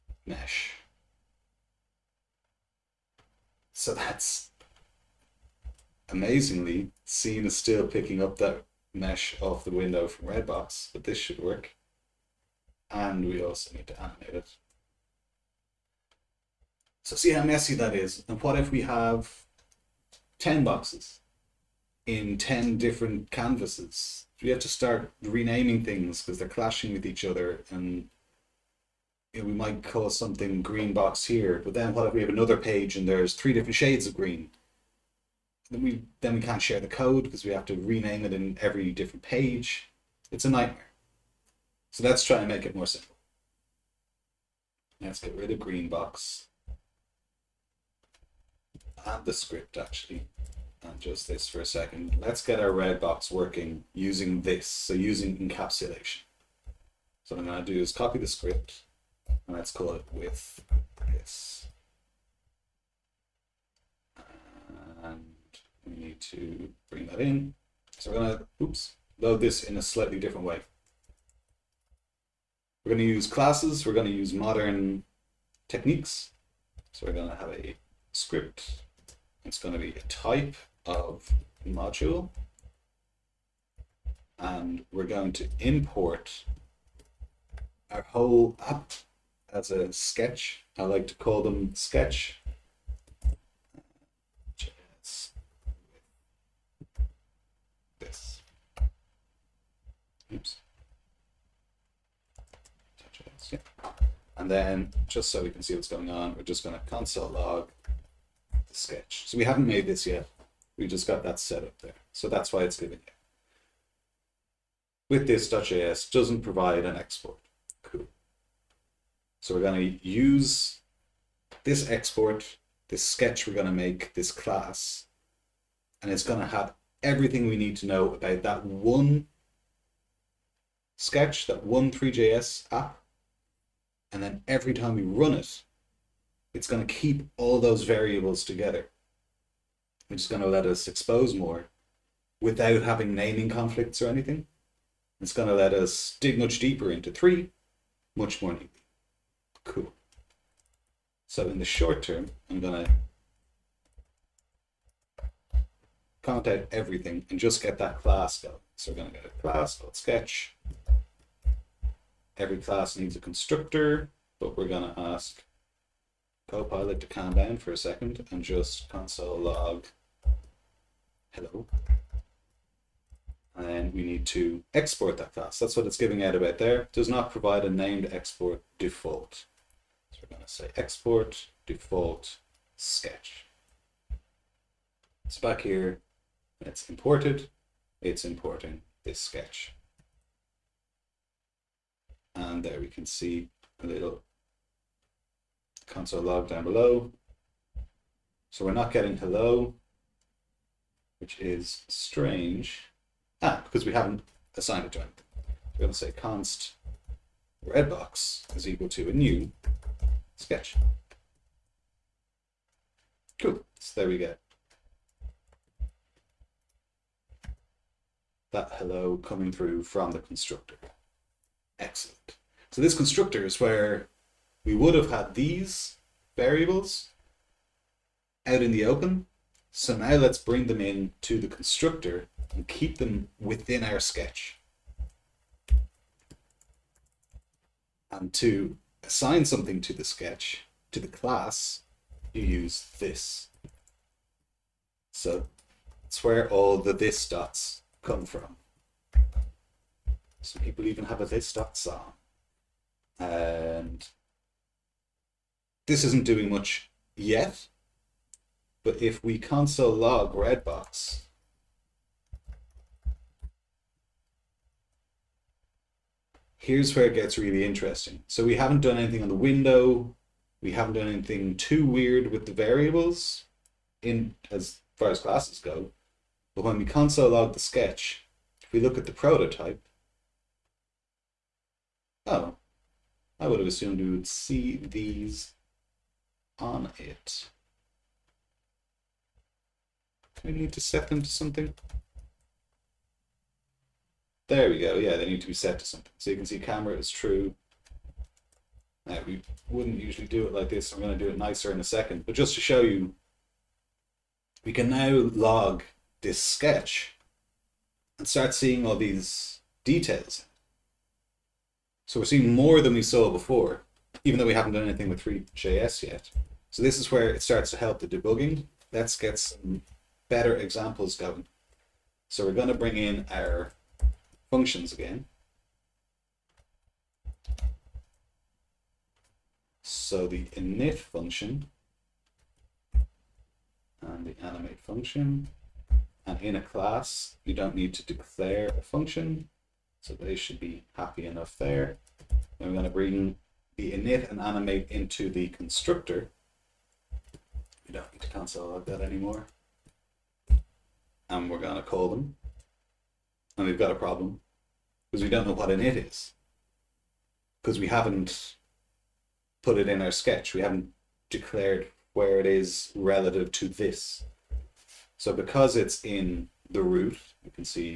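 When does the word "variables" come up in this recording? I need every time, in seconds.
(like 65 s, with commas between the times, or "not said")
137 s, 226 s, 272 s.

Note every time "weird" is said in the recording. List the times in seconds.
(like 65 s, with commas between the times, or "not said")
271 s.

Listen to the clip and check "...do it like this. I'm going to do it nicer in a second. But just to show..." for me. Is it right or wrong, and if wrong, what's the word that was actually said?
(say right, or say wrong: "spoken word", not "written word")
right.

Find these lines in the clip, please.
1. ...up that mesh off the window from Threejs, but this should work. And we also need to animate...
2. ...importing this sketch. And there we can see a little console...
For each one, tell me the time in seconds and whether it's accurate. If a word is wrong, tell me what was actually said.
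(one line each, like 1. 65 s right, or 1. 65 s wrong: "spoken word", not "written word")
1. 8 s wrong: "Redbox", not "Threejs"
2. 188 s right.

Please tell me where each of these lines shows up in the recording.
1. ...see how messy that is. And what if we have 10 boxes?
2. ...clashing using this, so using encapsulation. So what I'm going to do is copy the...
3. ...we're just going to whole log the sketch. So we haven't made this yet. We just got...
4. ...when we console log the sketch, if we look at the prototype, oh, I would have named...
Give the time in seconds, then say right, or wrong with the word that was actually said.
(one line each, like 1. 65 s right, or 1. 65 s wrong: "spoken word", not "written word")
1. 17 s right
2. 53 s wrong: "working", not "clashing"
3. 106 s wrong: "console", not "whole"
4. 276 s wrong: "assumed", not "named".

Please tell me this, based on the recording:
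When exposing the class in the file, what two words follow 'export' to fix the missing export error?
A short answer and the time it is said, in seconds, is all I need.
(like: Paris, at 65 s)
default sketch, at 181 s.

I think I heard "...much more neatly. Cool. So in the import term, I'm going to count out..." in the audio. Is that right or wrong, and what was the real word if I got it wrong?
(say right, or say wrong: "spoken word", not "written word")
wrong: "short", not "import".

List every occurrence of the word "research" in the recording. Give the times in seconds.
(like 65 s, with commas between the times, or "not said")
not said.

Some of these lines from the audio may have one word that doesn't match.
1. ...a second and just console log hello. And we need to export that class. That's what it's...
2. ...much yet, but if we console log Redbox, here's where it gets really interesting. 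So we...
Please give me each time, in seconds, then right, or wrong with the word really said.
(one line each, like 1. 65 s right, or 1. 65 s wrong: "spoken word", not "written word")
1. 167 s right
2. 256 s right.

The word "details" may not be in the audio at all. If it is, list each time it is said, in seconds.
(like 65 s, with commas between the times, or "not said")
309 s.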